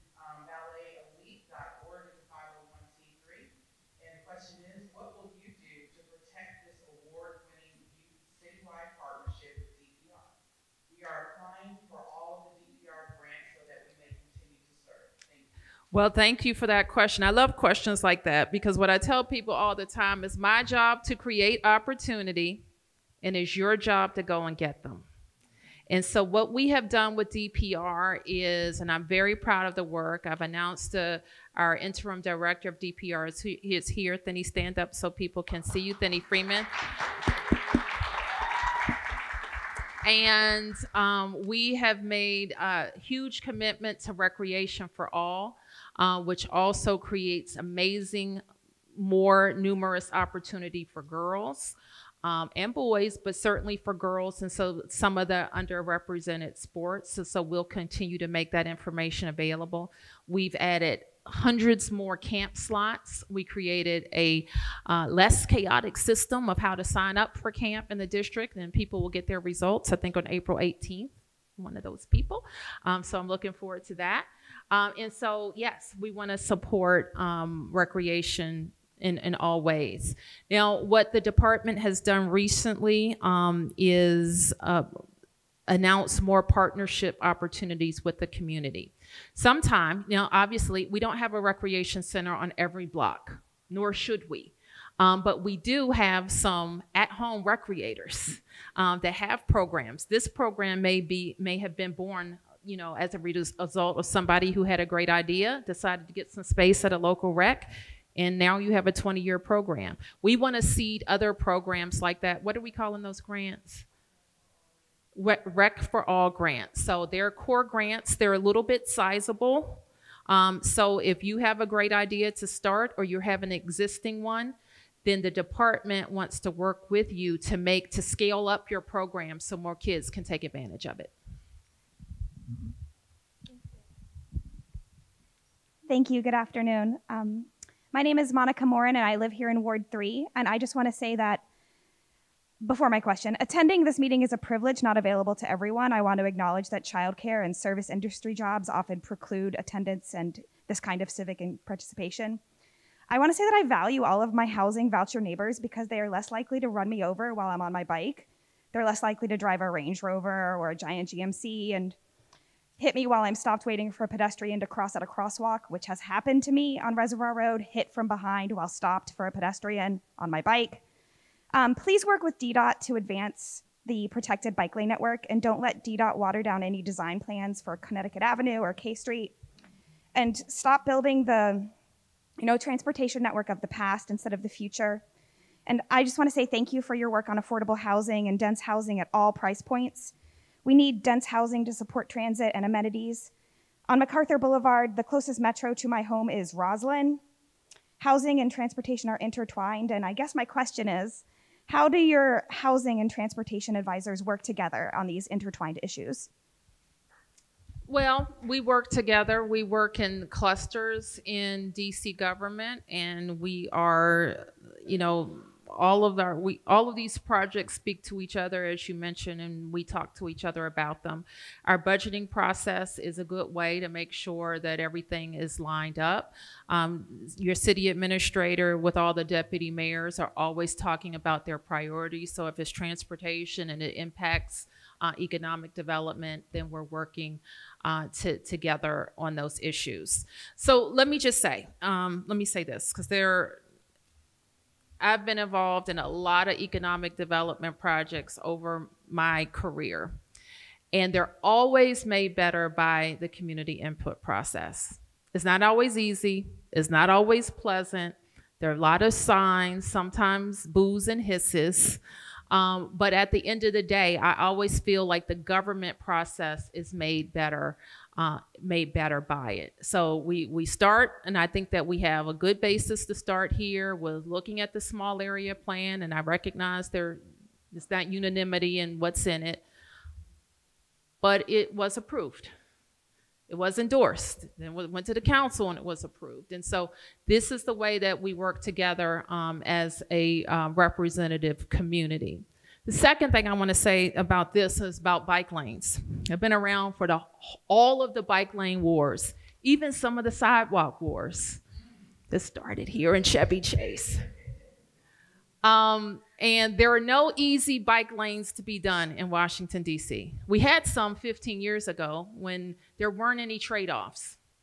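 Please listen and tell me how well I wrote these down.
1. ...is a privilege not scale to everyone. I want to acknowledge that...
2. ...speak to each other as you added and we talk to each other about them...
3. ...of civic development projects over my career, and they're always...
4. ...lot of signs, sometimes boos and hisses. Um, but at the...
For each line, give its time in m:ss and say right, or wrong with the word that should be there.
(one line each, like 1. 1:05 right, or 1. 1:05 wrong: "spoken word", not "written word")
1. 2:24 wrong: "available", not "scale"
2. 3:37 wrong: "mentioned", not "added"
3. 4:06 wrong: "economic", not "civic"
4. 4:18 right.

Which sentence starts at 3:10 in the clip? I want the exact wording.
We need dense housing to support transit and amenities.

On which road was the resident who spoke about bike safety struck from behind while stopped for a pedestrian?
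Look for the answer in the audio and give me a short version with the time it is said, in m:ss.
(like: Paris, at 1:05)
Reservoir Road, at 2:46.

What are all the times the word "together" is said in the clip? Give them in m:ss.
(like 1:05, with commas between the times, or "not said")
3:24, 3:28, 3:58, 4:48.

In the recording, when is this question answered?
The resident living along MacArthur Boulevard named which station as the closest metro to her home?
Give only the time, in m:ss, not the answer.
3:16.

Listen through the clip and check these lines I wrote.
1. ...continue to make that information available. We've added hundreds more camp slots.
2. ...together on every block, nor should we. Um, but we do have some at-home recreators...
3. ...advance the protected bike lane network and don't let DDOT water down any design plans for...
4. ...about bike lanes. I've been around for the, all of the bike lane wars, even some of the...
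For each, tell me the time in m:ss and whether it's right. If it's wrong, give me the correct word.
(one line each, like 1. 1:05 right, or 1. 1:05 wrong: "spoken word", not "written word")
1. 0:57 right
2. 1:32 wrong: "center", not "together"
3. 2:52 right
4. 4:54 right.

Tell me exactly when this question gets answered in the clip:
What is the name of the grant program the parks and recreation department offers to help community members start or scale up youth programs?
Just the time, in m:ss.
1:55.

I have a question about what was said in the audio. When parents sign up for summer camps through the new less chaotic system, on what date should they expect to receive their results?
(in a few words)
April 18th.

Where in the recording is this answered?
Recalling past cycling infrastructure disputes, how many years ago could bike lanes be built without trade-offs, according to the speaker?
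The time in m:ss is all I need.
5:11.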